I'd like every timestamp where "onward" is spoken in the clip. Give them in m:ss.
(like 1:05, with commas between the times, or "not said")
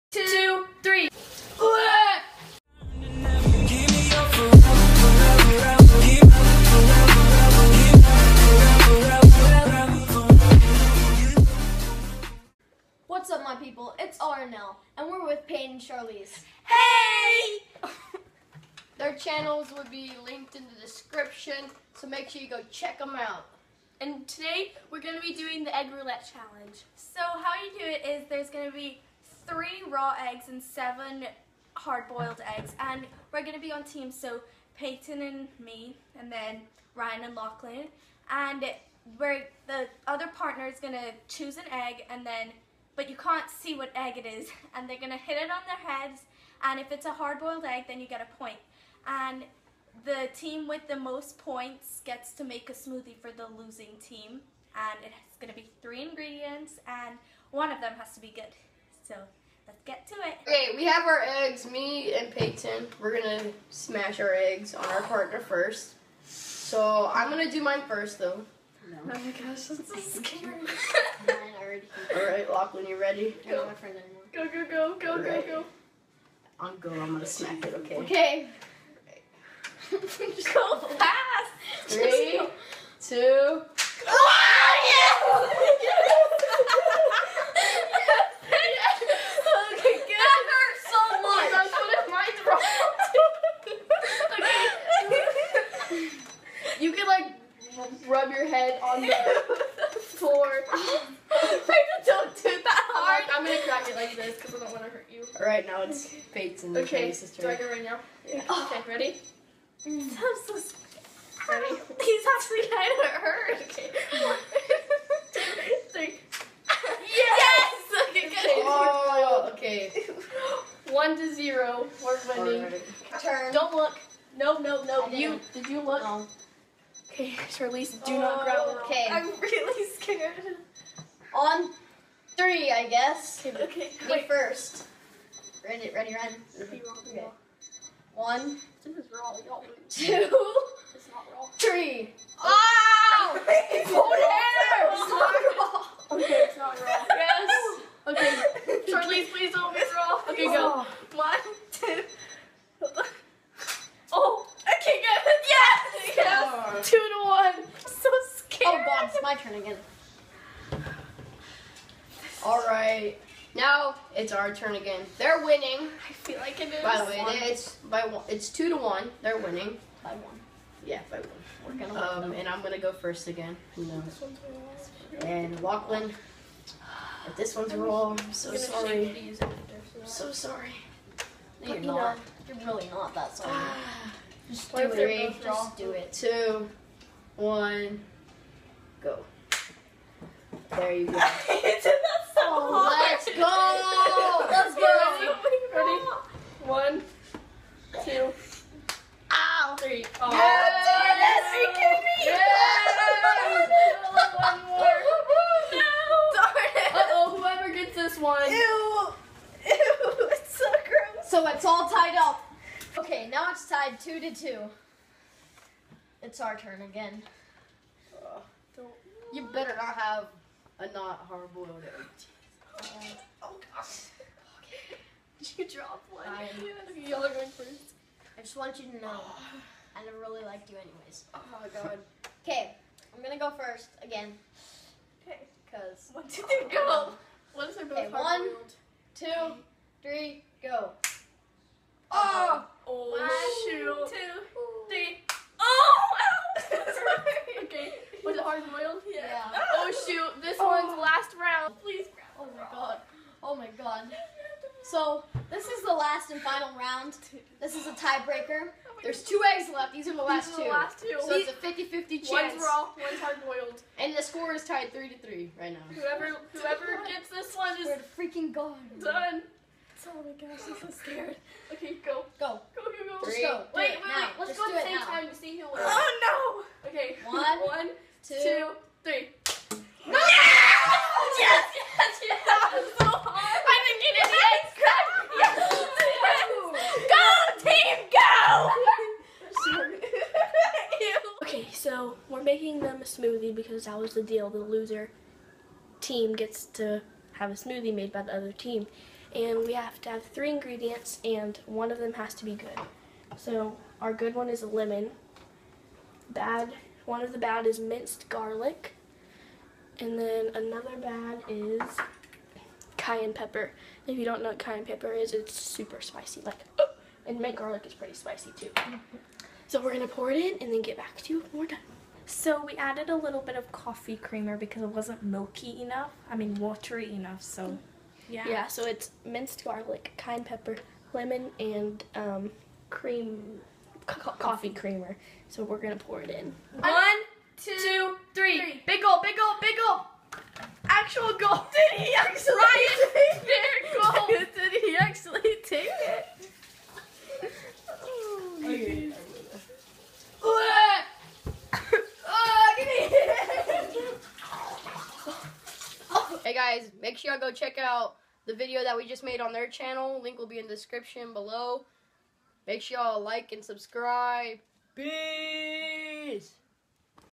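not said.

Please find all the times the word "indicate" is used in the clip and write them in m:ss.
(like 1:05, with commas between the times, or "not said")
not said.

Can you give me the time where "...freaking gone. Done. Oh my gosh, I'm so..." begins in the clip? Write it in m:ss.
4:28.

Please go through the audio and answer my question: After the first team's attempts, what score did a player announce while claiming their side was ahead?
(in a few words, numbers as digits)
1 to 0.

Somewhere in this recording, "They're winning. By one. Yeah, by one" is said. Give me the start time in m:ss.
2:49.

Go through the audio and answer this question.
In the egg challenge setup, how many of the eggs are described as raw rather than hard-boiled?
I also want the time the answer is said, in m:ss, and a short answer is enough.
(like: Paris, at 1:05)
3, at 0:29.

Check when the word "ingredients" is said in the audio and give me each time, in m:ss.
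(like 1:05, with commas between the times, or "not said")
0:56, 5:00.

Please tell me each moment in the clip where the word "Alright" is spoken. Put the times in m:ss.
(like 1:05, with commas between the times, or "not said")
1:12, 2:42.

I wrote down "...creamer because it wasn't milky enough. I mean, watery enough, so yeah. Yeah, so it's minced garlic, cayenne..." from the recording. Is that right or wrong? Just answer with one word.
right.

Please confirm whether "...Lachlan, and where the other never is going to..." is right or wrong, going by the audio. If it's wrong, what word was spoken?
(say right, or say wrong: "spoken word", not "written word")
wrong: "partner", not "never".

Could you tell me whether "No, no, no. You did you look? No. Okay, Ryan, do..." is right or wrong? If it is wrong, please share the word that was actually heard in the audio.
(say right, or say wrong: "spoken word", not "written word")
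wrong: "Charlize", not "Ryan".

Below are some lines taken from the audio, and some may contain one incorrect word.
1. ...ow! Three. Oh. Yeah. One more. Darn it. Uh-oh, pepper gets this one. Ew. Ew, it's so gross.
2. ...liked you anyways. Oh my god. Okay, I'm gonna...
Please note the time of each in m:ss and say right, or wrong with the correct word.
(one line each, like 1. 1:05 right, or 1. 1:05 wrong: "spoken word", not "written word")
1. 3:19 wrong: "whoever", not "pepper"
2. 3:50 right.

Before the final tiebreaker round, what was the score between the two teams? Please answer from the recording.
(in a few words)
3 to 3.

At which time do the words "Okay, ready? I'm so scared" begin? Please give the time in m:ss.
1:48.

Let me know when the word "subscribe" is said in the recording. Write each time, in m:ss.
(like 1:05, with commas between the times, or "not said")
6:03.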